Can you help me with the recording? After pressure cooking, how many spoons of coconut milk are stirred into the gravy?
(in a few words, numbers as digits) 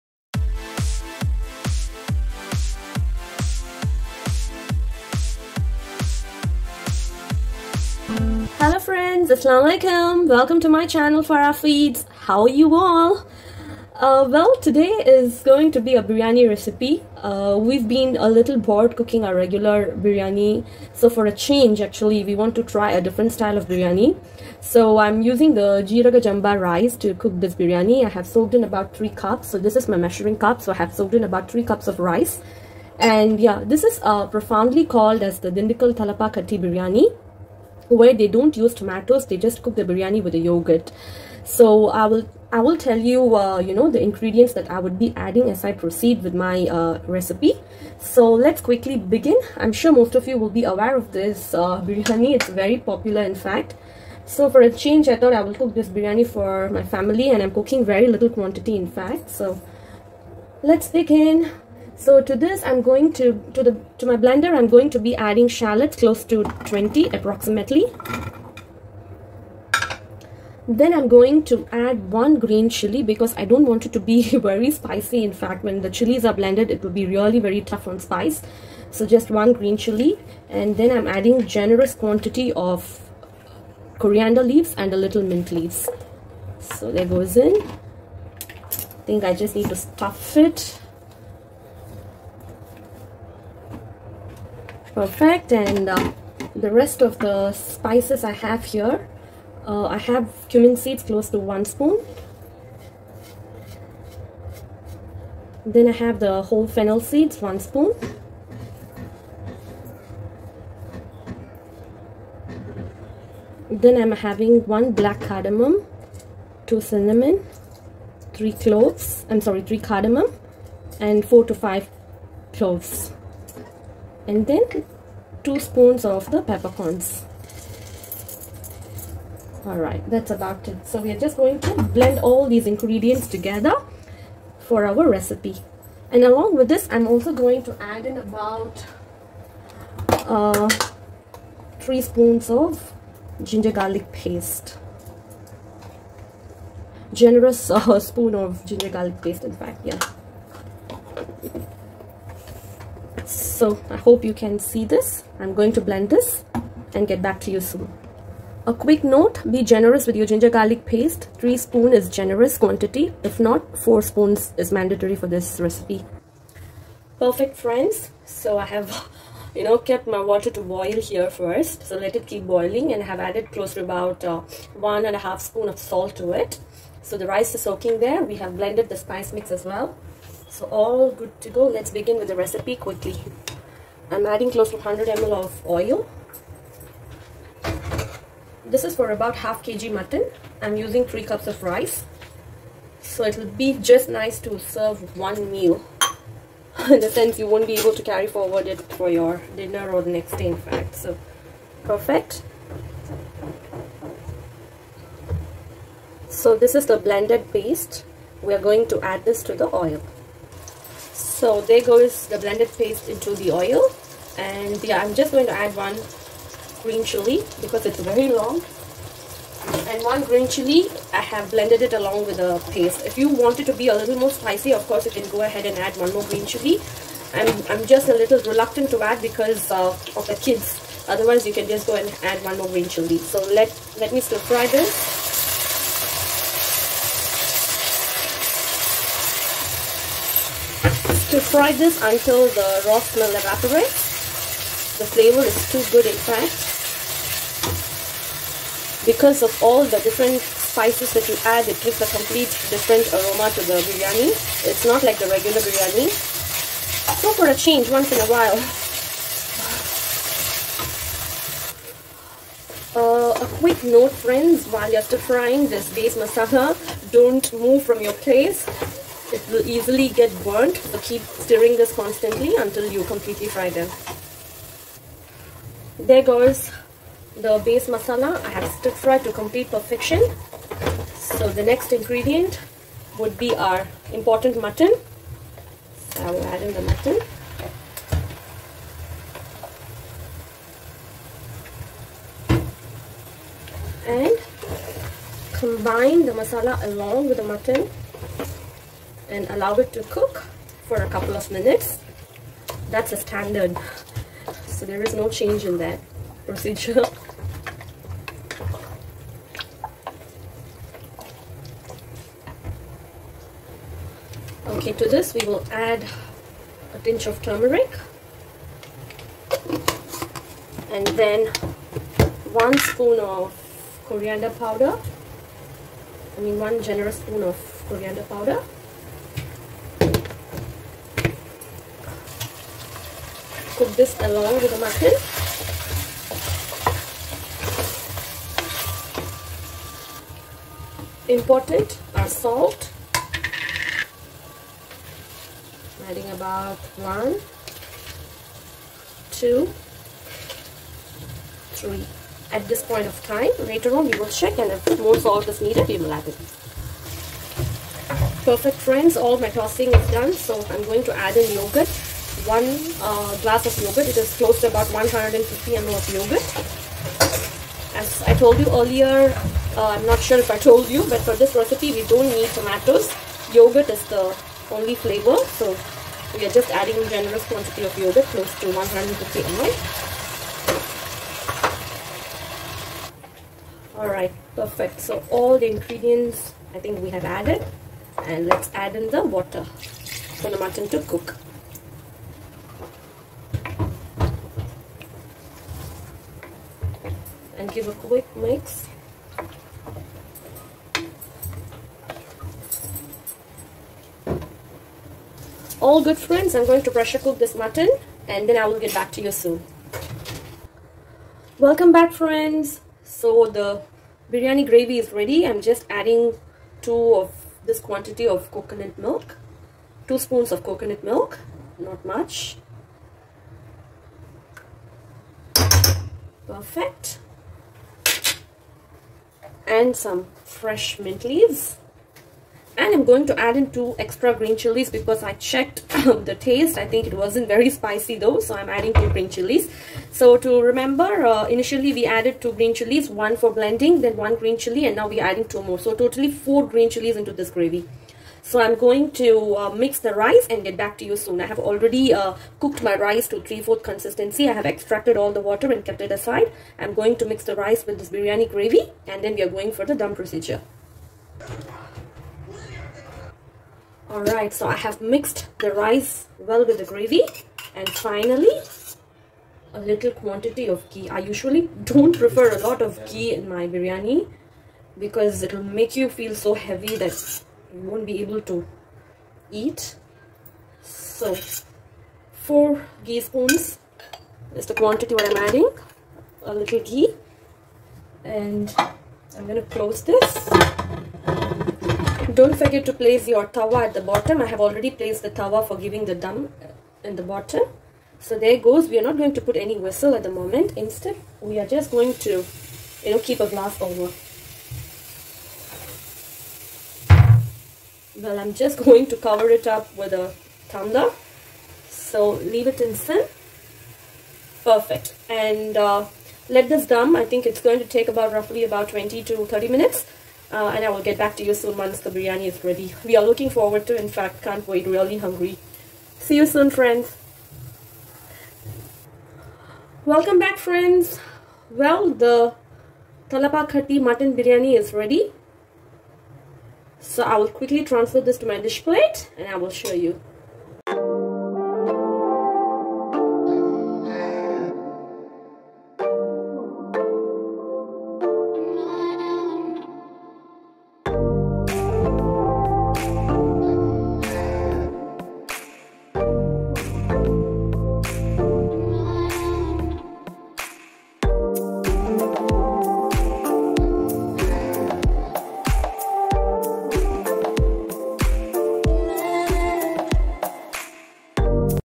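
2.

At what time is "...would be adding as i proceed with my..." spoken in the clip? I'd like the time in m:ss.
0:44.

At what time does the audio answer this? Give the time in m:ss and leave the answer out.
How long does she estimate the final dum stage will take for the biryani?
8:38.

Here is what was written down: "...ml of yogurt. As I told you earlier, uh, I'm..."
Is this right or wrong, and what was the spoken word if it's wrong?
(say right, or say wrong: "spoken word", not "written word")
right.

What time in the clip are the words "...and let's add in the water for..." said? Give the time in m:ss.
6:28.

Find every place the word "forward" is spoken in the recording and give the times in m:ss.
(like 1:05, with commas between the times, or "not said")
3:18, 8:43.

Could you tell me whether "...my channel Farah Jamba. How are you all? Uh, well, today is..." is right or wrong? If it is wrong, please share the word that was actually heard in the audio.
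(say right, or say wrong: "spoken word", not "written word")
wrong: "Feeds", not "Jamba".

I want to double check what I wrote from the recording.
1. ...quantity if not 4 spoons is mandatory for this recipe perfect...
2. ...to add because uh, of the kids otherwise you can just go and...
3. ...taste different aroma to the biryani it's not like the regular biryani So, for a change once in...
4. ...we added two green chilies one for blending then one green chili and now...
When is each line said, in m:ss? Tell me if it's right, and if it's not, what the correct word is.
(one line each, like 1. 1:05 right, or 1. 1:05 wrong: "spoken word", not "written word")
1. 2:42 right
2. 3:48 right
3. 4:12 wrong: "complete", not "taste"
4. 7:21 right.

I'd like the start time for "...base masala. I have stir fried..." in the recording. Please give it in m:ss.
4:37.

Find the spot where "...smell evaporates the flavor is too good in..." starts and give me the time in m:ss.
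4:02.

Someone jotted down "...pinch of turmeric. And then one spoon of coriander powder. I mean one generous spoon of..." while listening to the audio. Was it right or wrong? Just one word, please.
right.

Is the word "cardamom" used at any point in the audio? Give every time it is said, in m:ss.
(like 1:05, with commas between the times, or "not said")
1:55, 1:59.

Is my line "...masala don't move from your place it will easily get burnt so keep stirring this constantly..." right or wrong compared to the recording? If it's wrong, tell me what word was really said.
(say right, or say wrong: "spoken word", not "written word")
right.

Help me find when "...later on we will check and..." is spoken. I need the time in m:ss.
5:53.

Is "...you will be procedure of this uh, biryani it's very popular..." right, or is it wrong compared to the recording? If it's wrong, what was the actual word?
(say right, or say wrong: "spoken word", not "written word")
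wrong: "aware", not "procedure".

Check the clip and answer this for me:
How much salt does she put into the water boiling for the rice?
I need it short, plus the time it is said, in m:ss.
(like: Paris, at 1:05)
1.5 spoons, at 2:54.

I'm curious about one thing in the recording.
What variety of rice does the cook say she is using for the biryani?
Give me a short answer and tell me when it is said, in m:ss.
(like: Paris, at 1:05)
Jeeraga Jamba, at 0:25.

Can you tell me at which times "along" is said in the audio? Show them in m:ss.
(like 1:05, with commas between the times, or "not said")
2:16, 3:41, 4:56, 5:34.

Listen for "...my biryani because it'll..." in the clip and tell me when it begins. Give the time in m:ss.
7:53.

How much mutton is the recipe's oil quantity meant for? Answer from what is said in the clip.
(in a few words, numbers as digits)
half kg.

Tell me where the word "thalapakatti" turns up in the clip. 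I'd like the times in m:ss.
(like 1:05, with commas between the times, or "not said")
0:35, 8:53.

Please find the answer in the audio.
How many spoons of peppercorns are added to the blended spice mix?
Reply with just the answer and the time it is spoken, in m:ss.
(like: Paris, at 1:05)
2, at 2:05.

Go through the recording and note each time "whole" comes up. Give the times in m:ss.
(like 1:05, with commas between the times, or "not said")
1:46.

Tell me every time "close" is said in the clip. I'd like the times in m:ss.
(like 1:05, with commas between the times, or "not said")
1:05, 1:41, 2:53, 3:04, 6:04, 6:18, 8:09.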